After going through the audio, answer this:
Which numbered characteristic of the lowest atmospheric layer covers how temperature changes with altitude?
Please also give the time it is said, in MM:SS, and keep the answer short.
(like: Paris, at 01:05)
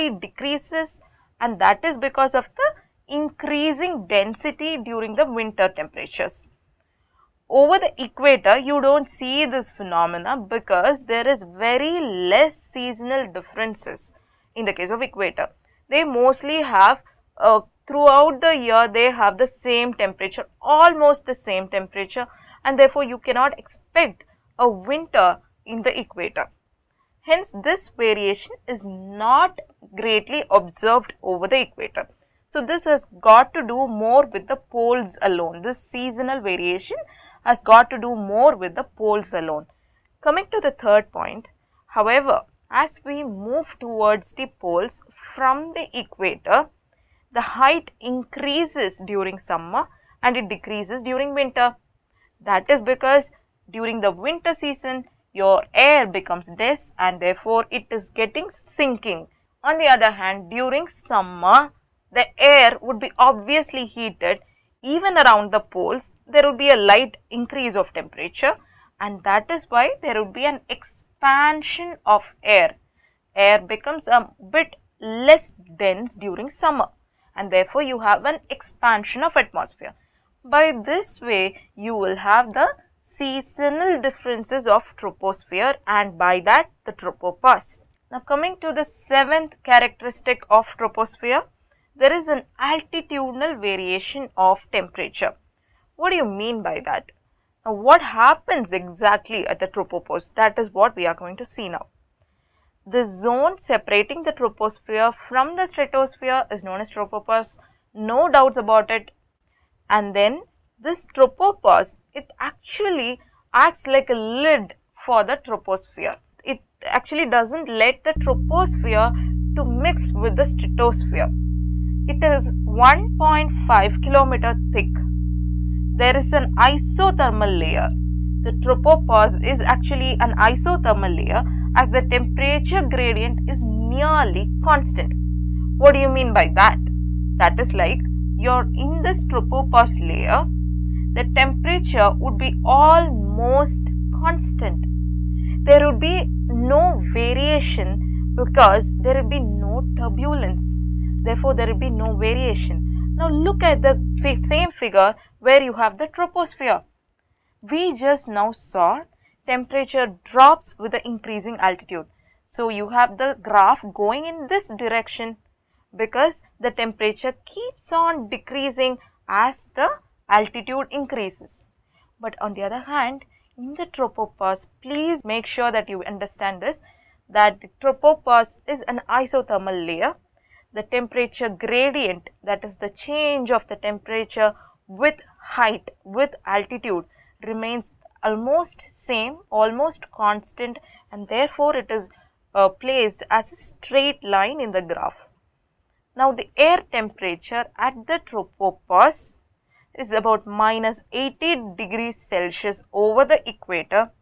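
Seventh, at 01:28.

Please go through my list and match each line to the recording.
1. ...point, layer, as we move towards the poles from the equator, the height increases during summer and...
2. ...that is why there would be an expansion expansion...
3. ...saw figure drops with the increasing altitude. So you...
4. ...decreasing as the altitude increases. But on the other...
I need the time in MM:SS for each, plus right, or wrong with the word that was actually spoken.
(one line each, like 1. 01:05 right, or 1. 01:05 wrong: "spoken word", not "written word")
1. 00:41 wrong: "however", not "layer"
2. 01:09 right
3. 02:38 wrong: "temperature", not "figure"
4. 02:48 right.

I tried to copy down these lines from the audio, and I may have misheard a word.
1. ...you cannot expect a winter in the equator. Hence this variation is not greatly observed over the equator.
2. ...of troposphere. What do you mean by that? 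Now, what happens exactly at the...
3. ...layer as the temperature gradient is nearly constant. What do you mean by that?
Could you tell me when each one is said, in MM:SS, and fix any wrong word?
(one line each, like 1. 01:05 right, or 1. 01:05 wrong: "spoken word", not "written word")
1. 00:23 right
2. 01:34 wrong: "temperature", not "troposphere"
3. 02:11 right.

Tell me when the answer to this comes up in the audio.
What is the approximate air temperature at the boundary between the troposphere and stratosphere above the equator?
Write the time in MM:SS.
03:20.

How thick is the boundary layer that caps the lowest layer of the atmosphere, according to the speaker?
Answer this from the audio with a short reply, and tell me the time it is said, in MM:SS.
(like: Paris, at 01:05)
1.5 kilometers, at 02:02.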